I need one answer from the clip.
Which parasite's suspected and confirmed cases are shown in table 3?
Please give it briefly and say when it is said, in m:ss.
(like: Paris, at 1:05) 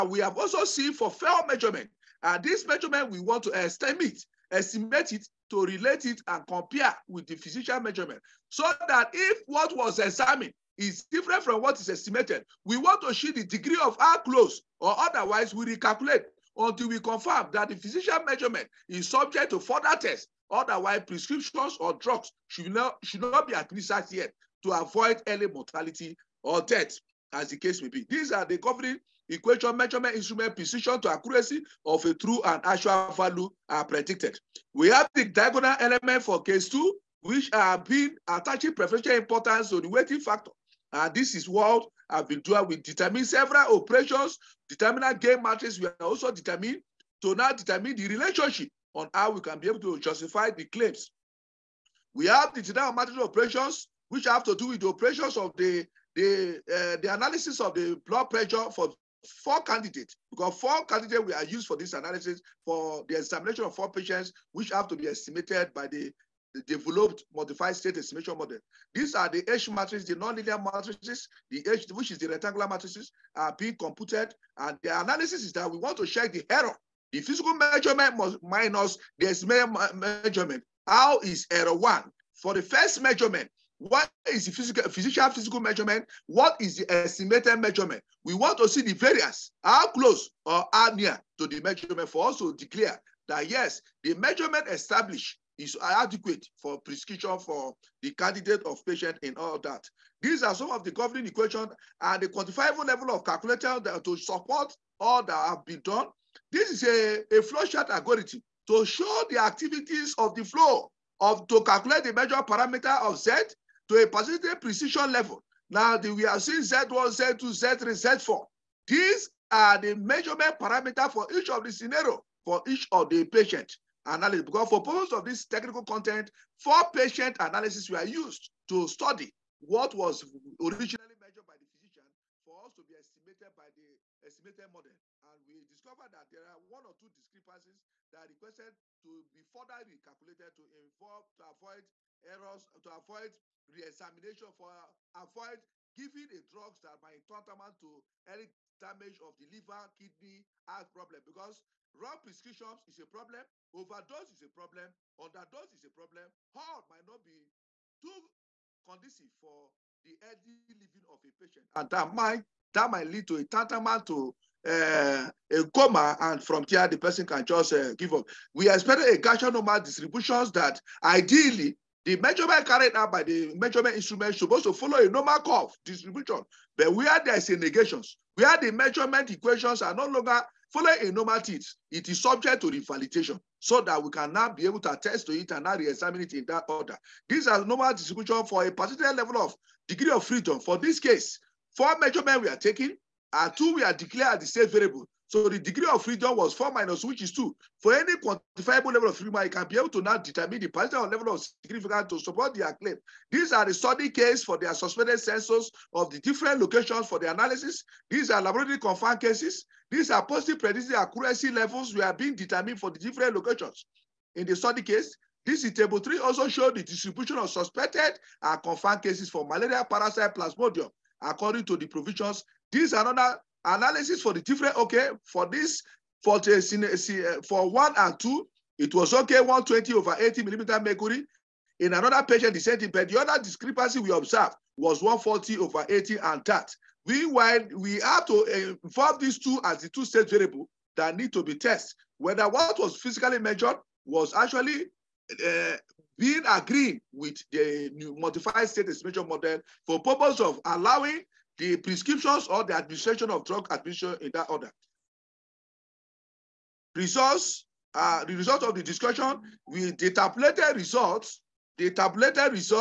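malaria parasite plasmodium, at 3:39.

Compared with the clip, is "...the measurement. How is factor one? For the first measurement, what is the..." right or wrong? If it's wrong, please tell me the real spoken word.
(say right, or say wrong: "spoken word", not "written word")
wrong: "error", not "factor".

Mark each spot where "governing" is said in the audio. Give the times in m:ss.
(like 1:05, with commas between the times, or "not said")
0:28, 1:40.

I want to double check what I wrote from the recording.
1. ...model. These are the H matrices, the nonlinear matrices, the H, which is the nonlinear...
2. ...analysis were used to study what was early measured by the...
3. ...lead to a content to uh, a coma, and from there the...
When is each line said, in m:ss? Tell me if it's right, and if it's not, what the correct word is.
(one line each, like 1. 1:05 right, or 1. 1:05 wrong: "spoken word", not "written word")
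1. 1:08 wrong: "rectangular", not "nonlinear"
2. 2:07 wrong: "originally", not "early"
3. 2:43 wrong: "tantamount", not "content".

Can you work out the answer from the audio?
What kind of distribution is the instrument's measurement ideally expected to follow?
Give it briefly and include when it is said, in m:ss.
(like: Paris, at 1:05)
normal curve distribution, at 2:55.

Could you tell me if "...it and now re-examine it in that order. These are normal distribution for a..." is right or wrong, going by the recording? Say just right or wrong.
right.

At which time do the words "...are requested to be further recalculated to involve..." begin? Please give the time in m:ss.
2:18.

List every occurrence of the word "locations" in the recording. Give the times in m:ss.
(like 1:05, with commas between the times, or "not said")
3:26, 3:33.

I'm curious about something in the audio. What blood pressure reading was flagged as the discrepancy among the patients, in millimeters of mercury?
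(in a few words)
140 over 80.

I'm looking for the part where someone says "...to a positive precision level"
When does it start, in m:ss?
1:53.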